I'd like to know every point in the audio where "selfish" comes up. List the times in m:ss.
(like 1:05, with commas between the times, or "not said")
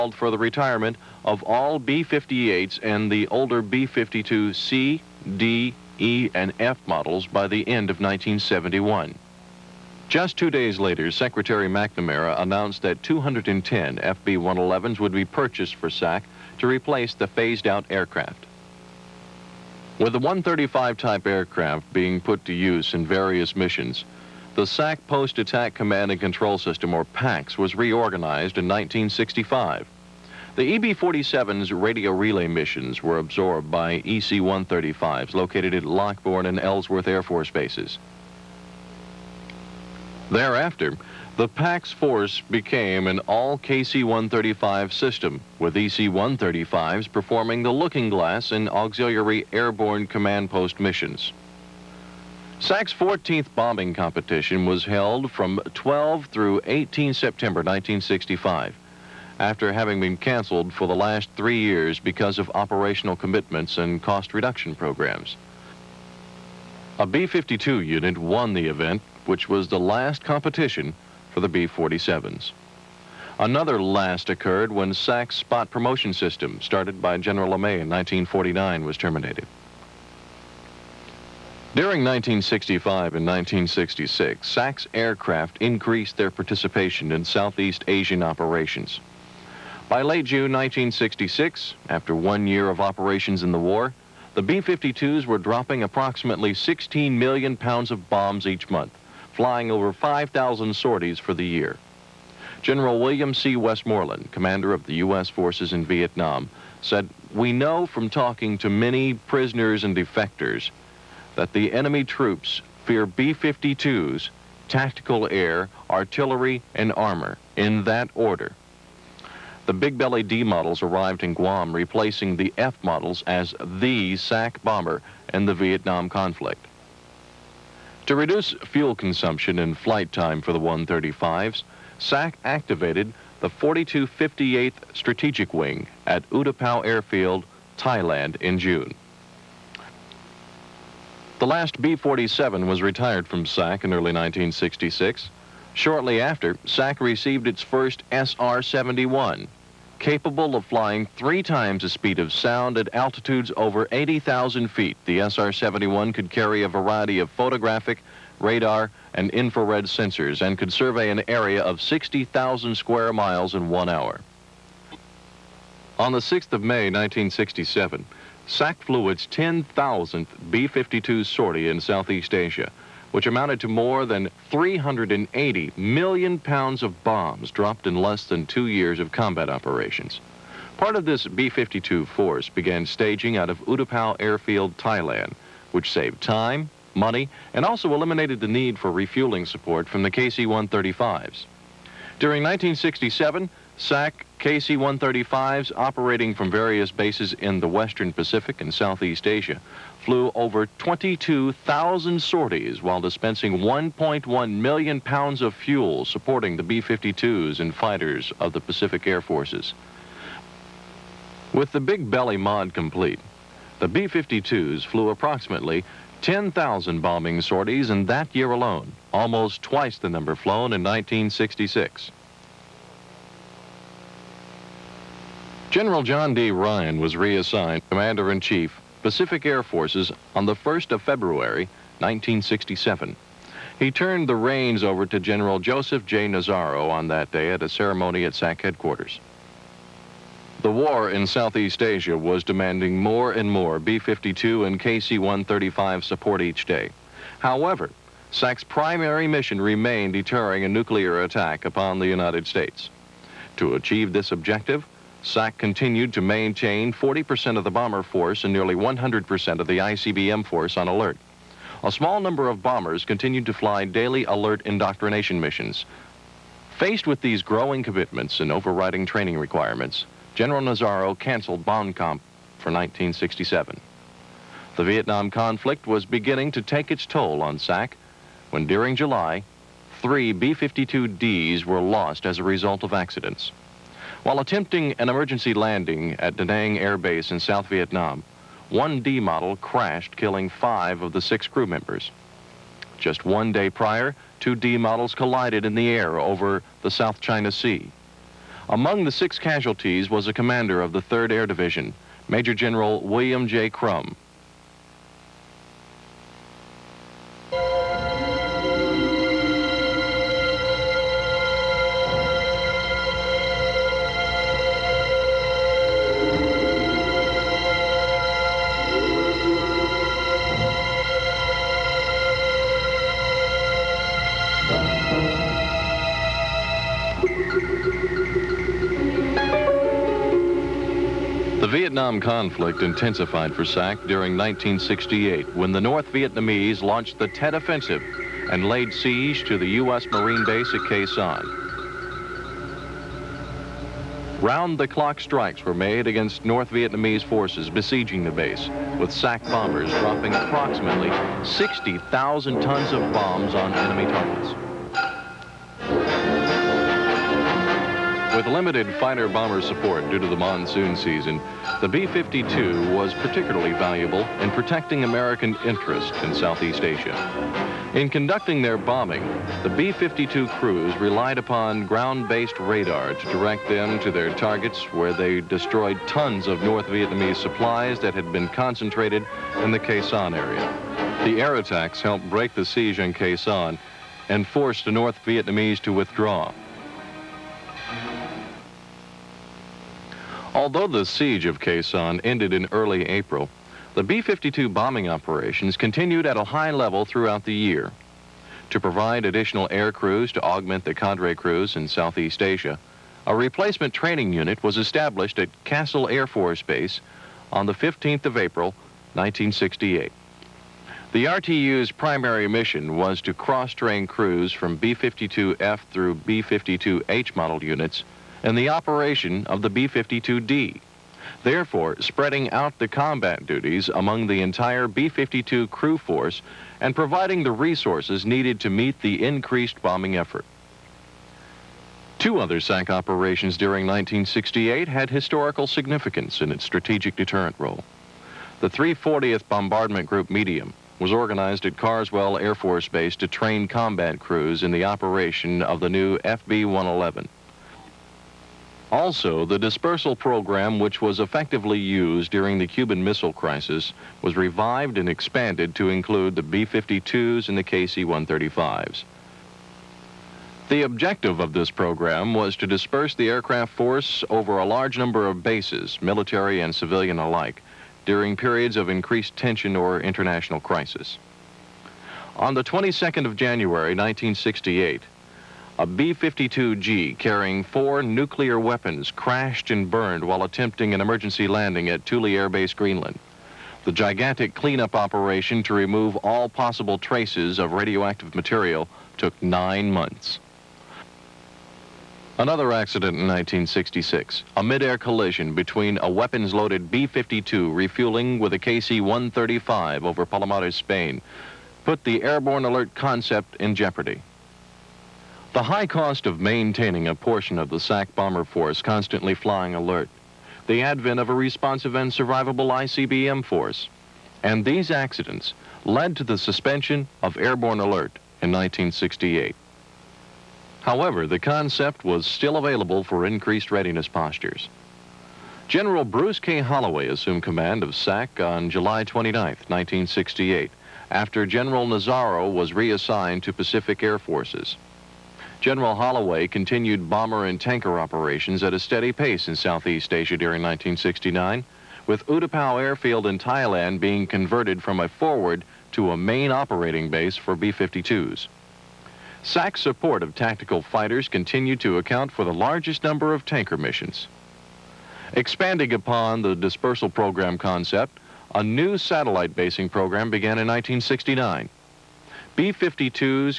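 not said.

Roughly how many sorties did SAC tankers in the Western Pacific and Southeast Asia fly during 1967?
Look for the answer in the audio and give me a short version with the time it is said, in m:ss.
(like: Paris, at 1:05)
22,000, at 3:20.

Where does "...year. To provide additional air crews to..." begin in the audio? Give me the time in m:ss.
6:37.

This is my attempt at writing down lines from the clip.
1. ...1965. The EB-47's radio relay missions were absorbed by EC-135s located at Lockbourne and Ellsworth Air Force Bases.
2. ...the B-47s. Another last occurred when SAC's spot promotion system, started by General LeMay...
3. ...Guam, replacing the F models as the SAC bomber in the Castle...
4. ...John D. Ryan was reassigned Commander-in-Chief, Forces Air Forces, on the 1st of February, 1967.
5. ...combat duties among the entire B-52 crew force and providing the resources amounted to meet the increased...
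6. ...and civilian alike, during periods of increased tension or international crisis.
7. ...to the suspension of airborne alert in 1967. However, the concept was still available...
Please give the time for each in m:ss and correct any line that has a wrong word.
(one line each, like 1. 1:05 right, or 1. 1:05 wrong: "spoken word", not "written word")
1. 0:28 right
2. 1:11 right
3. 2:01 wrong: "Vietnam", not "Castle"
4. 3:46 wrong: "Pacific", not "Forces"
5. 7:02 wrong: "needed", not "amounted"
6. 7:46 right
7. 8:36 wrong: "1968", not "1967".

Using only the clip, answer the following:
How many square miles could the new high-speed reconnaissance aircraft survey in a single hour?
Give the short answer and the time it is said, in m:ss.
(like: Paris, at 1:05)
60,000, at 2:41.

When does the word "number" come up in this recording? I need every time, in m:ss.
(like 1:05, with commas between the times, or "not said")
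3:40, 4:22, 7:44, 9:13.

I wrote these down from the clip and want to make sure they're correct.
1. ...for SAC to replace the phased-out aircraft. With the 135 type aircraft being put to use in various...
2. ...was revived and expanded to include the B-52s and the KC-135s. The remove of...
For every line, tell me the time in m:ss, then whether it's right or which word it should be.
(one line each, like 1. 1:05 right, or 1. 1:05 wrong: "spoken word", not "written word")
1. 0:15 right
2. 7:34 wrong: "objective", not "remove".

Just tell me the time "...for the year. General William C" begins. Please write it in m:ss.
1:41.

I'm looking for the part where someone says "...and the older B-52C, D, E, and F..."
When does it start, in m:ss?
0:02.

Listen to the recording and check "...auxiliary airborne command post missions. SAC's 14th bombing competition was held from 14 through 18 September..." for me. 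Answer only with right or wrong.
wrong.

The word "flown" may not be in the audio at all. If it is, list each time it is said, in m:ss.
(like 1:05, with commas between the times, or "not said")
3:40.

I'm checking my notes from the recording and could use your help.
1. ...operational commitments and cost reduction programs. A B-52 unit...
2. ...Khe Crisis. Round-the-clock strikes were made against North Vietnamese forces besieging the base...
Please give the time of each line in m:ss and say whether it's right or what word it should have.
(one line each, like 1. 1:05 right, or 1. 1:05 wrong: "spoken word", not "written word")
1. 1:02 right
2. 5:40 wrong: "Sanh", not "Crisis".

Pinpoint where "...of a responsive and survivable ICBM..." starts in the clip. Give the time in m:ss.
8:31.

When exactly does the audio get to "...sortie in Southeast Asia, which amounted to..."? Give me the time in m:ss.
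2:51.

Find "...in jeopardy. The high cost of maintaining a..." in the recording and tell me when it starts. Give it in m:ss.
8:23.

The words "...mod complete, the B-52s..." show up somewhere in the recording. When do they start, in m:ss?
3:32.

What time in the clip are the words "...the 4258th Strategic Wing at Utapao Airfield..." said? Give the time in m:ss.
2:13.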